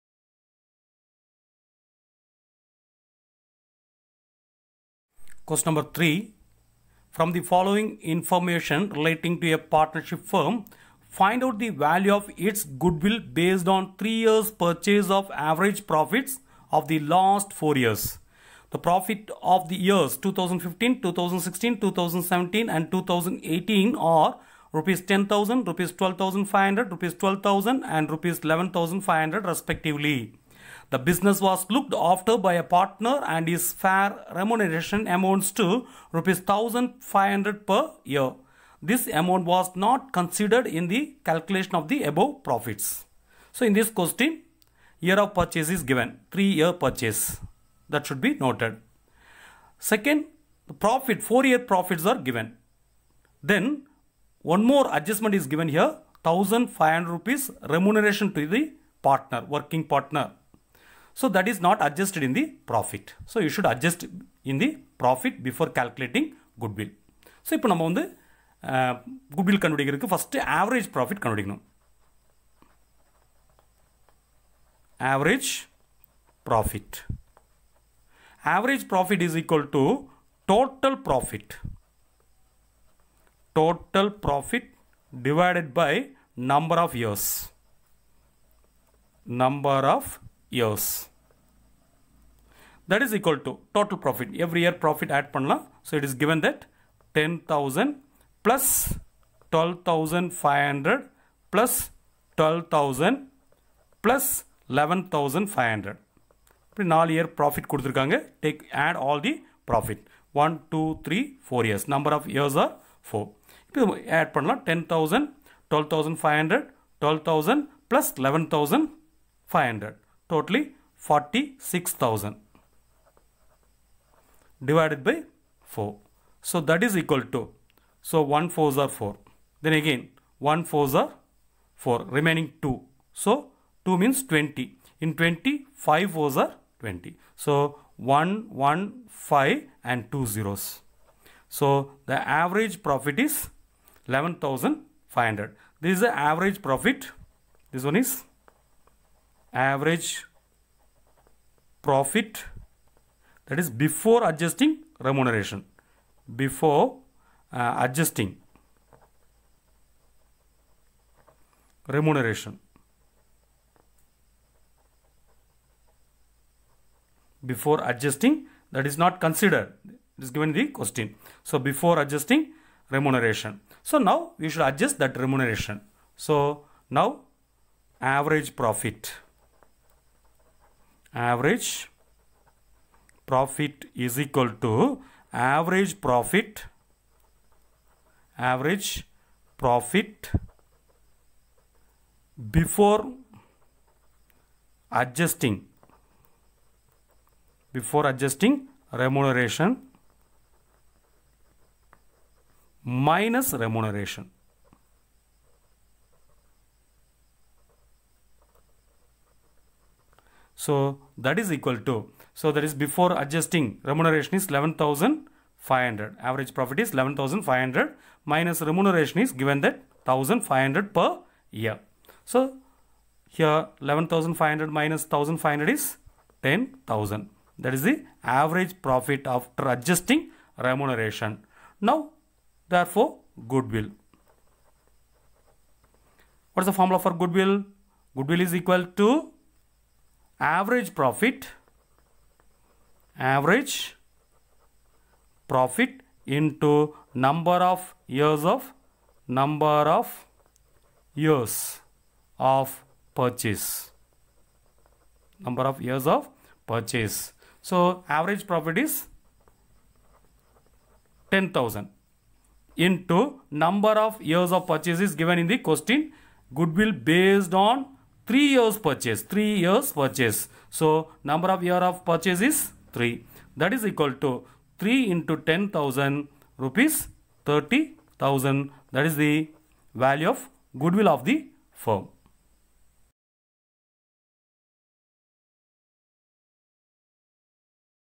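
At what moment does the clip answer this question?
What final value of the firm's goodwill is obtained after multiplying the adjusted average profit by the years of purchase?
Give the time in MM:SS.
04:36.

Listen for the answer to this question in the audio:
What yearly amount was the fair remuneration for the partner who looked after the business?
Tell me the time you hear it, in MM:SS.
00:36.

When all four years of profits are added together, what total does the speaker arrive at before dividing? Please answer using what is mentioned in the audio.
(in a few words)
46,000.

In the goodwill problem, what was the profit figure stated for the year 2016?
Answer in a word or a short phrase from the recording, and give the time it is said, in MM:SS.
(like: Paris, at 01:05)
₹12,500, at 00:25.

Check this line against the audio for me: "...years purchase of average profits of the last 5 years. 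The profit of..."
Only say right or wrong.
wrong.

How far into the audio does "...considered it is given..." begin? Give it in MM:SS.
02:49.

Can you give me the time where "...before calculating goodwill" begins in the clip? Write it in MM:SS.
01:05.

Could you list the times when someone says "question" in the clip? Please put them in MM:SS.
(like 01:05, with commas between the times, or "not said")
00:05, 00:43, 02:50, 04:25.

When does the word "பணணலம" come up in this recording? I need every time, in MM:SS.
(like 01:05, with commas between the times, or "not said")
01:35, 01:54.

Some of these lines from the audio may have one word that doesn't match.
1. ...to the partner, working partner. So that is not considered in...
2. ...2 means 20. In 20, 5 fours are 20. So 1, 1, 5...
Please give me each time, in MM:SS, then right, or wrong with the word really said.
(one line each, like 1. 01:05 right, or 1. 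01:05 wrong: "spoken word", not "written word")
1. 00:58 wrong: "adjusted", not "considered"
2. 02:13 right.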